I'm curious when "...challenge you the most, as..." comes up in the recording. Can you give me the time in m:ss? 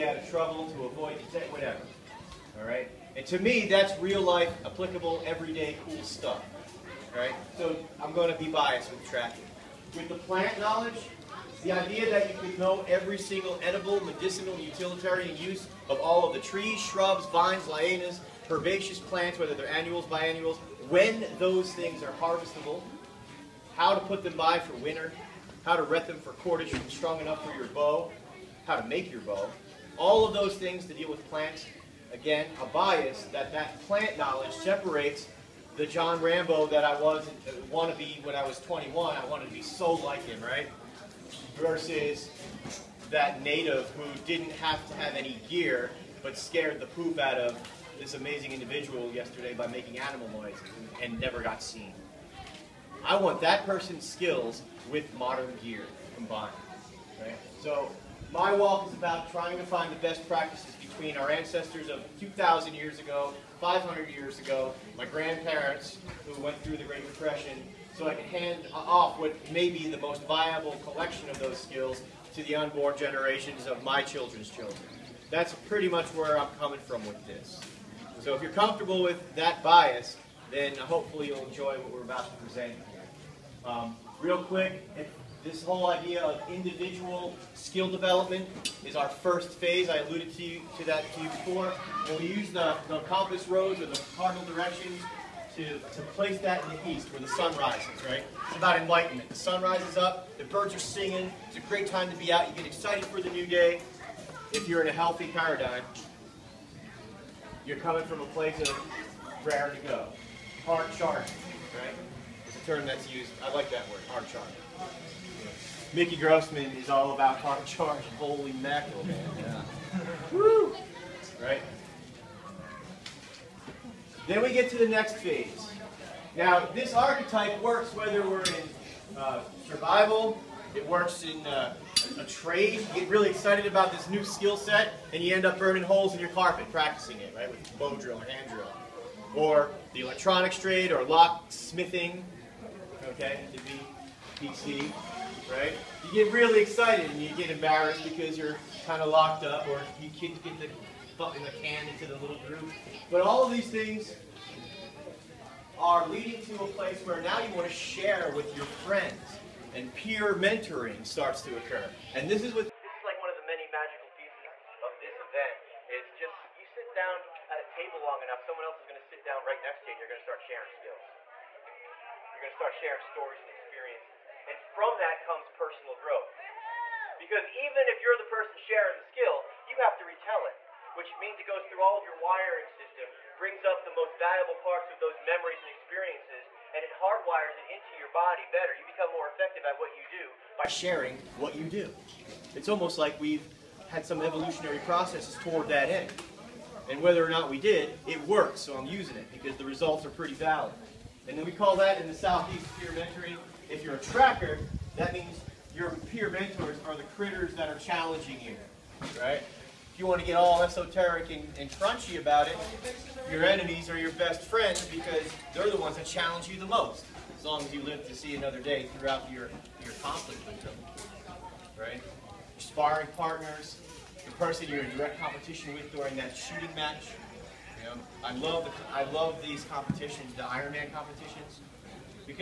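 3:36.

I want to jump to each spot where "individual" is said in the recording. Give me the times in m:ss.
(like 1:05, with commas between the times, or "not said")
0:48, 1:26.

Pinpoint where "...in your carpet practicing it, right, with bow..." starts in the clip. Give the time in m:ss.
2:16.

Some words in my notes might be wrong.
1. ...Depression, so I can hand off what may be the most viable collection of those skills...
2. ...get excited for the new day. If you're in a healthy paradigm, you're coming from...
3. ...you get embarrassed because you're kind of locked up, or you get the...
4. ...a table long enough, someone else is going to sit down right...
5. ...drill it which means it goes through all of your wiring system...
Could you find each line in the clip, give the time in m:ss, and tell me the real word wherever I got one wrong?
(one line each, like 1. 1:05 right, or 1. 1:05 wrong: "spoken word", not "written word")
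1. 1:07 right
2. 1:42 right
3. 2:27 right
4. 2:47 right
5. 3:00 wrong: "retell", not "drill".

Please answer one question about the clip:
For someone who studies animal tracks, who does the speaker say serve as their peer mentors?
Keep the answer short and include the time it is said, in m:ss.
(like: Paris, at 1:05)
the critters, at 3:26.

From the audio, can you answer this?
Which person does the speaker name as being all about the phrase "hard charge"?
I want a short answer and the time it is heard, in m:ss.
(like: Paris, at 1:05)
Mickey Grossman, at 1:55.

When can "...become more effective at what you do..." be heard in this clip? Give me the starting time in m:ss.
3:08.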